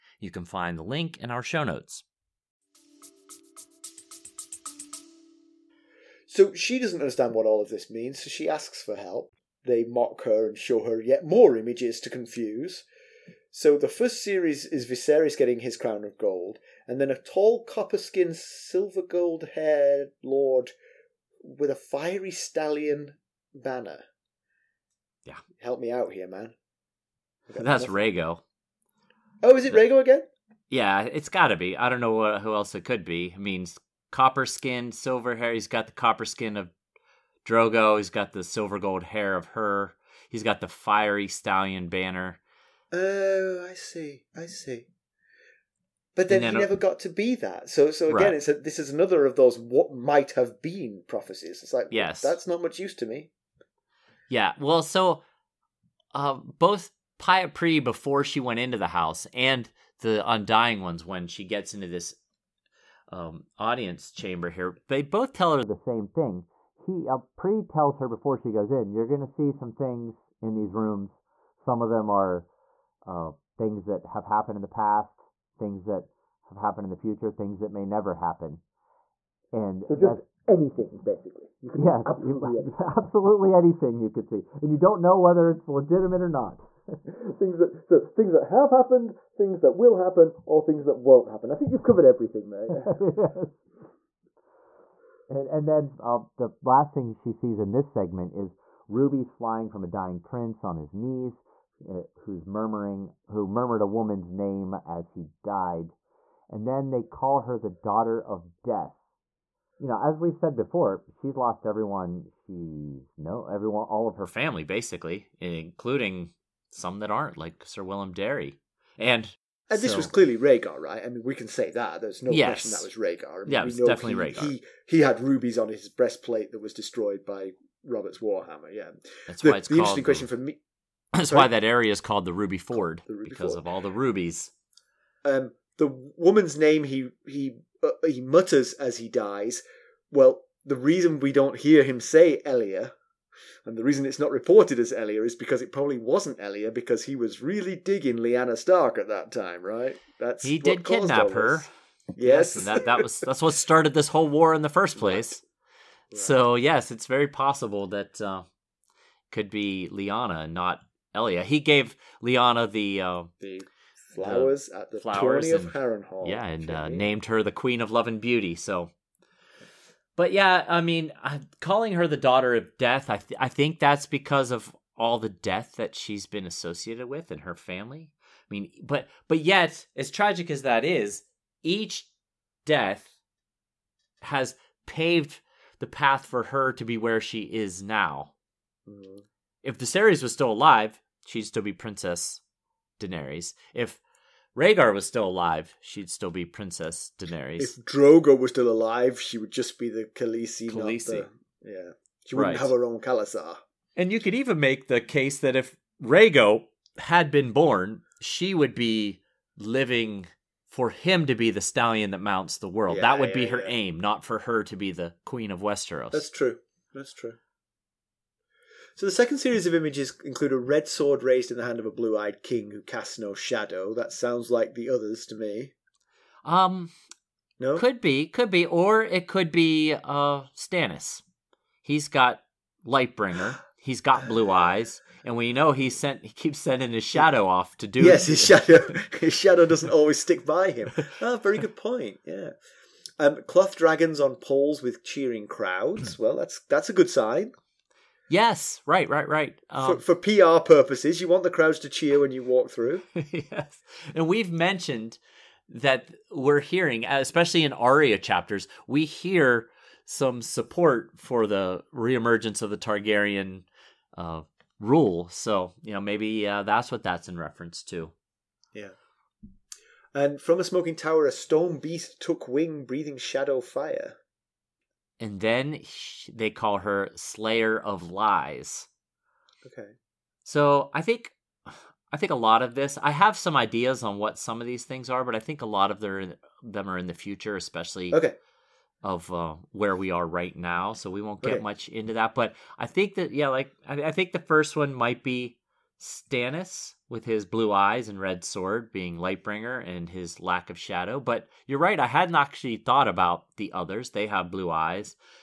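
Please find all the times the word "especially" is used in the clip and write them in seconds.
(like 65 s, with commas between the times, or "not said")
257 s, 287 s.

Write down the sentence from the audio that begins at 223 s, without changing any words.
That sounds like the others to me.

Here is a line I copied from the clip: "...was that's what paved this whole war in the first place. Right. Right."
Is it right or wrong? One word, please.
wrong.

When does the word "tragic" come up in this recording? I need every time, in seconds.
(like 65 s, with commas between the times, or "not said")
180 s.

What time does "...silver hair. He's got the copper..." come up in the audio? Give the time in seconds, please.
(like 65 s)
34 s.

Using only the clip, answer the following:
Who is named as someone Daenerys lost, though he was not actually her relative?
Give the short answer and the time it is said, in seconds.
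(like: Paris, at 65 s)
Sir Willem Darry, at 117 s.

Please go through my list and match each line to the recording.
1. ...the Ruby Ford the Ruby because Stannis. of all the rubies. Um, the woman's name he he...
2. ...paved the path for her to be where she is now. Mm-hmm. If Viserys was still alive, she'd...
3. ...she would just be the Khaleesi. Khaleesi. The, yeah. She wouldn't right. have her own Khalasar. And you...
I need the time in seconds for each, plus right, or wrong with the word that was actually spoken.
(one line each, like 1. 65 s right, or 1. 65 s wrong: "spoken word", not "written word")
1. 132 s wrong: "Ford", not "Stannis"
2. 184 s right
3. 199 s right.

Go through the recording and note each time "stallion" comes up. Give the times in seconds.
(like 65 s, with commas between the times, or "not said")
22 s, 41 s, 211 s.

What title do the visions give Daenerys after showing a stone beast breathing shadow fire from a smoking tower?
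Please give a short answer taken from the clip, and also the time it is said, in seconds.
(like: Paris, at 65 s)
Slayer of Lies, at 277 s.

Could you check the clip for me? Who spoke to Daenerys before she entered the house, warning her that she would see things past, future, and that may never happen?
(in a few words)
Pyat Pree.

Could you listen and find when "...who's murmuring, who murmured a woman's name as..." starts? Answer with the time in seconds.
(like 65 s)
102 s.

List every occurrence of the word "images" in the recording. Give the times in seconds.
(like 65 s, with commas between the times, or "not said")
11 s, 219 s.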